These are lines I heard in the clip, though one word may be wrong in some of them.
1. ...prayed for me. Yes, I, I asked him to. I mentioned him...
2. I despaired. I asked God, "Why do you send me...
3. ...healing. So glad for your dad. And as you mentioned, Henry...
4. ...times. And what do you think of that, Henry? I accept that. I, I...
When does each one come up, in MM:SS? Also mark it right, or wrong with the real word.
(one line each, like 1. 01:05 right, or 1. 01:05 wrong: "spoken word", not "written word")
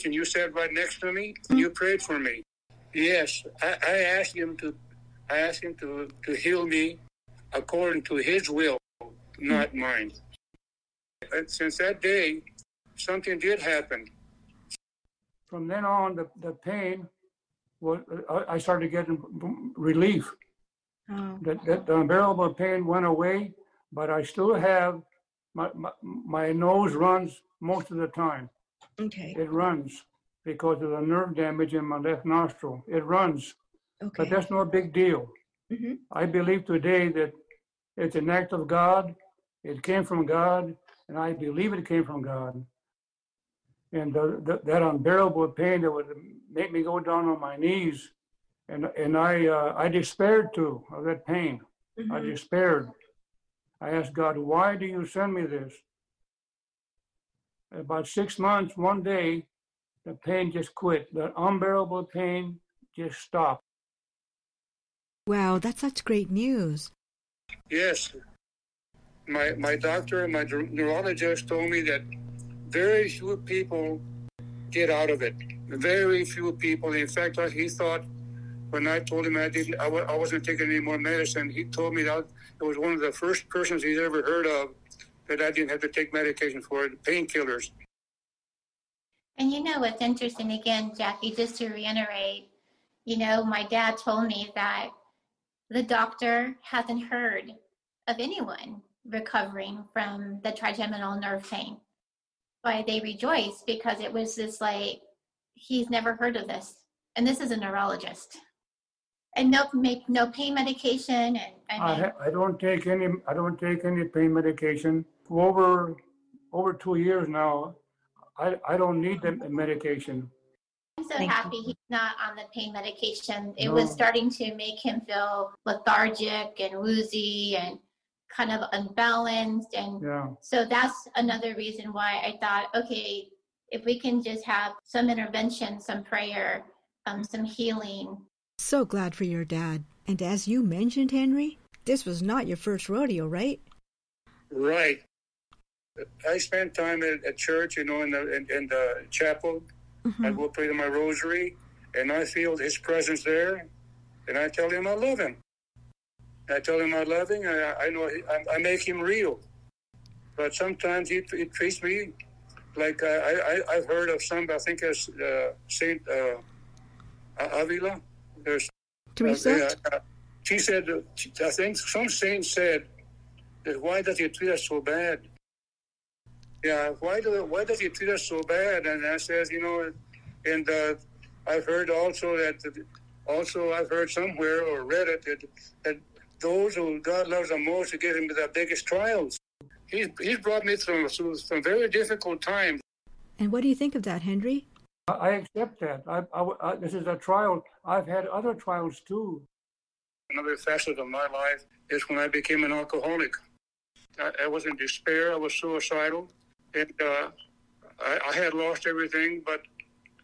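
1. 00:01 wrong: "asked", not "mentioned"
2. 00:52 right
3. 02:17 right
4. 03:12 right.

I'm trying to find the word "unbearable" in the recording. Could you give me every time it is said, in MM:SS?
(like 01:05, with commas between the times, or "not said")
00:21, 00:44, 01:01.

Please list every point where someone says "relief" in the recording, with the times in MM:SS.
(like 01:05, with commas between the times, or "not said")
00:19.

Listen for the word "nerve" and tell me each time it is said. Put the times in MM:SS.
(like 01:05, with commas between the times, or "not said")
00:30, 01:41.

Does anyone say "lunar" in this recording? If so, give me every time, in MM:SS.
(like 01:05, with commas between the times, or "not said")
not said.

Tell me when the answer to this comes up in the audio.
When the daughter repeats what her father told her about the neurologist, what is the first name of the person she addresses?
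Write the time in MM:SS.
01:30.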